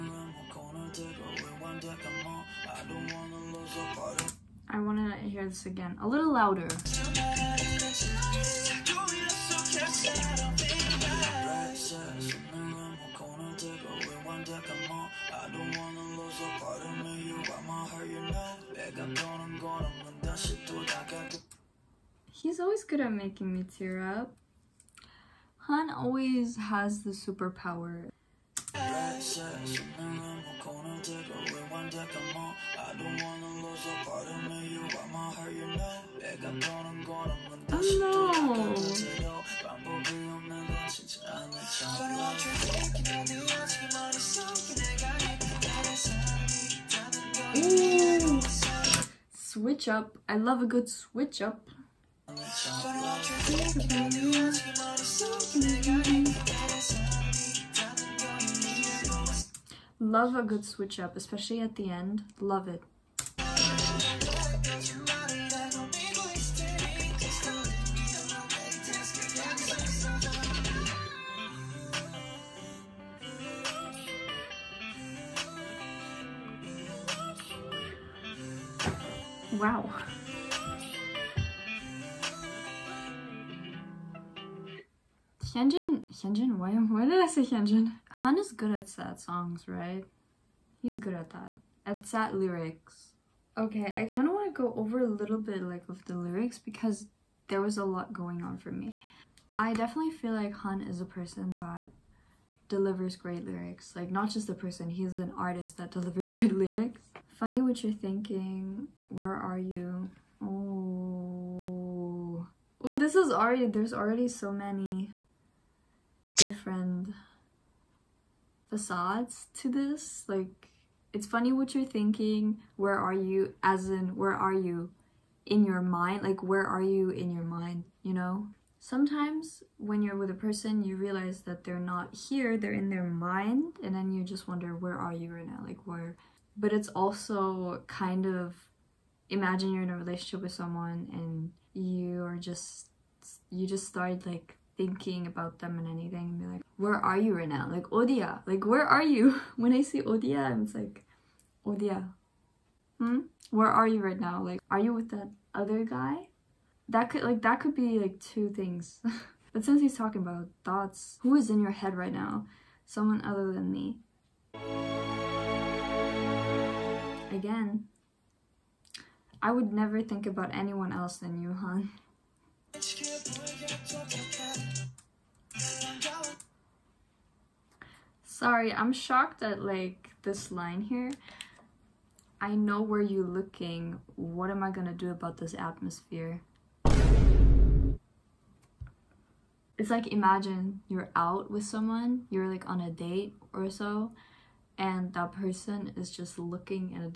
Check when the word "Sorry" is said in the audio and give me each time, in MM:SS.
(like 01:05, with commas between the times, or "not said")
02:58.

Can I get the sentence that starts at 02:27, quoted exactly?
Like, Odia, like, where are you?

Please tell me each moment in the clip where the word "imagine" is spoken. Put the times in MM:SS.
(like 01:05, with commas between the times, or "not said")
02:19, 03:10.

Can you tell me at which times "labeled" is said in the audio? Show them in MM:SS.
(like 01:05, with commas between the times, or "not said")
not said.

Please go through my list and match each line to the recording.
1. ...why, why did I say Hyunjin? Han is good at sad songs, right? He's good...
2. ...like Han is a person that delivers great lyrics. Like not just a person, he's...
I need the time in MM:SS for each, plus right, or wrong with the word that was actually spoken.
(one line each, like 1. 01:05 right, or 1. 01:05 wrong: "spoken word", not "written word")
1. 01:26 right
2. 01:40 right.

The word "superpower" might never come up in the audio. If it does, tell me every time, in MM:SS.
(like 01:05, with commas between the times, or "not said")
00:27.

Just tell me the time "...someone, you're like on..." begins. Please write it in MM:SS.
03:11.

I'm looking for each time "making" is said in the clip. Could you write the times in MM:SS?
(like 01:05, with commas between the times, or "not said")
00:23.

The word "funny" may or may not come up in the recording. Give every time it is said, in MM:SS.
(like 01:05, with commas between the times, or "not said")
01:47, 02:01.